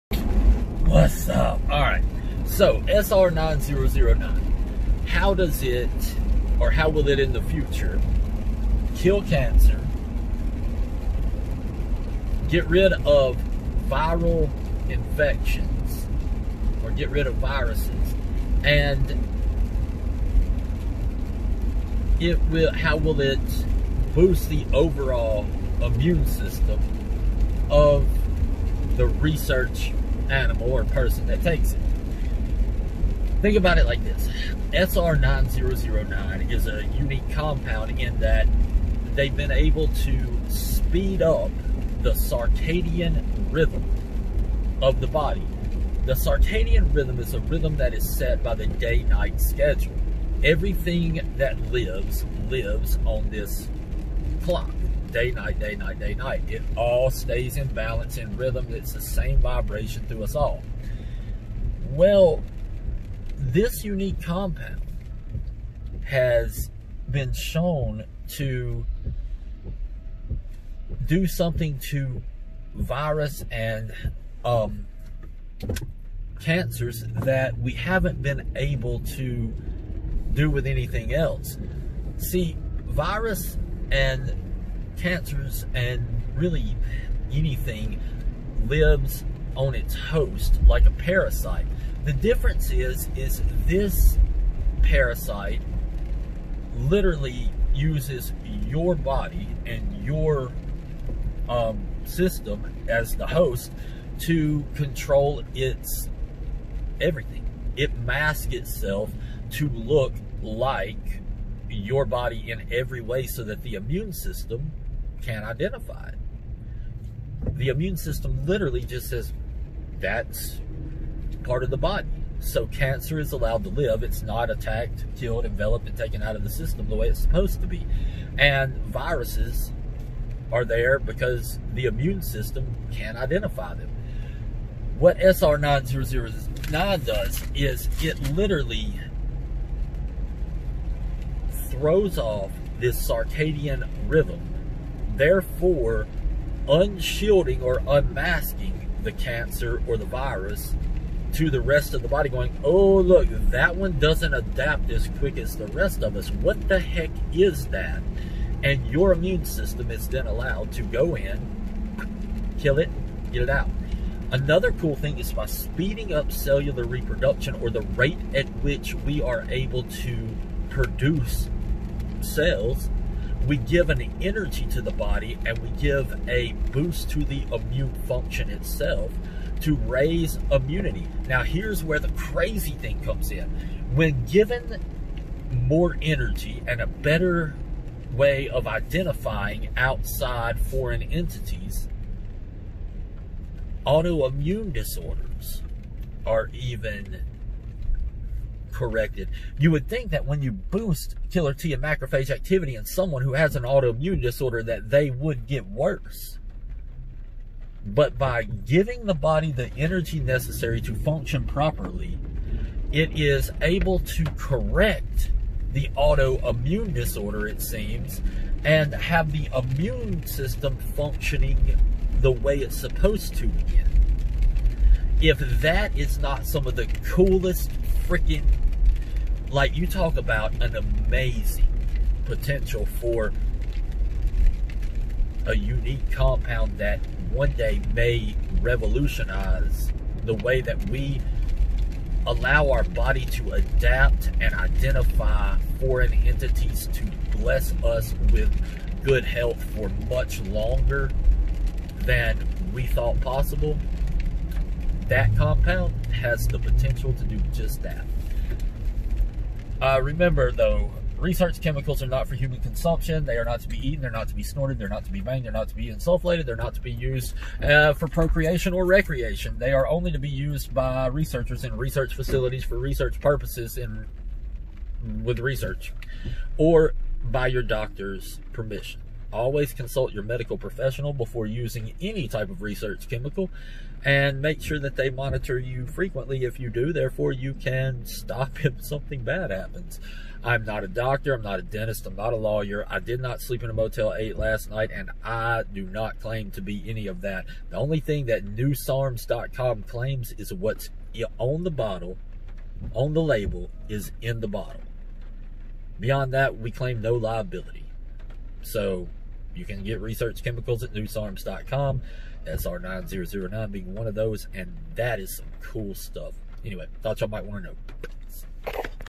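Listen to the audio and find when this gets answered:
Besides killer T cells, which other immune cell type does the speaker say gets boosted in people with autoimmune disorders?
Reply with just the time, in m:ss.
3:21.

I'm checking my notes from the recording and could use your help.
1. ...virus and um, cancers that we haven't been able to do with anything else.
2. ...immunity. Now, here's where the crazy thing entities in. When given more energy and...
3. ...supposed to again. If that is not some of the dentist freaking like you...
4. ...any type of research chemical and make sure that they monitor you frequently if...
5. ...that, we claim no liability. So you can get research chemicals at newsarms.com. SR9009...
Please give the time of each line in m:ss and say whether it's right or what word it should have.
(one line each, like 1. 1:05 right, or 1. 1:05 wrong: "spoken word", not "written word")
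1. 1:12 right
2. 3:00 wrong: "comes", not "entities"
3. 3:42 wrong: "coolest", not "dentist"
4. 4:42 right
5. 5:06 right.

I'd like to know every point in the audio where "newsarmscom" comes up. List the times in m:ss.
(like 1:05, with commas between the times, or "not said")
4:58, 5:10.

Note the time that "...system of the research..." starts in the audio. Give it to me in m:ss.
0:26.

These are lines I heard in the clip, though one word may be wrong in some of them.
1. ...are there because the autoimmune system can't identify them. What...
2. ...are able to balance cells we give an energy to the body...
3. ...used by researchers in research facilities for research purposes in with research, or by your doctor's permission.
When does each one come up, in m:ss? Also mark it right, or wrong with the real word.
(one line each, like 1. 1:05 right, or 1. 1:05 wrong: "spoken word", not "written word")
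1. 2:10 wrong: "immune", not "autoimmune"
2. 2:49 wrong: "produce", not "balance"
3. 4:30 right.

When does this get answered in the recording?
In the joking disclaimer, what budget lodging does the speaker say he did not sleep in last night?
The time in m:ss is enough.
4:53.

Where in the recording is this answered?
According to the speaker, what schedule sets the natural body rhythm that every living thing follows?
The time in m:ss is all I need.
0:48.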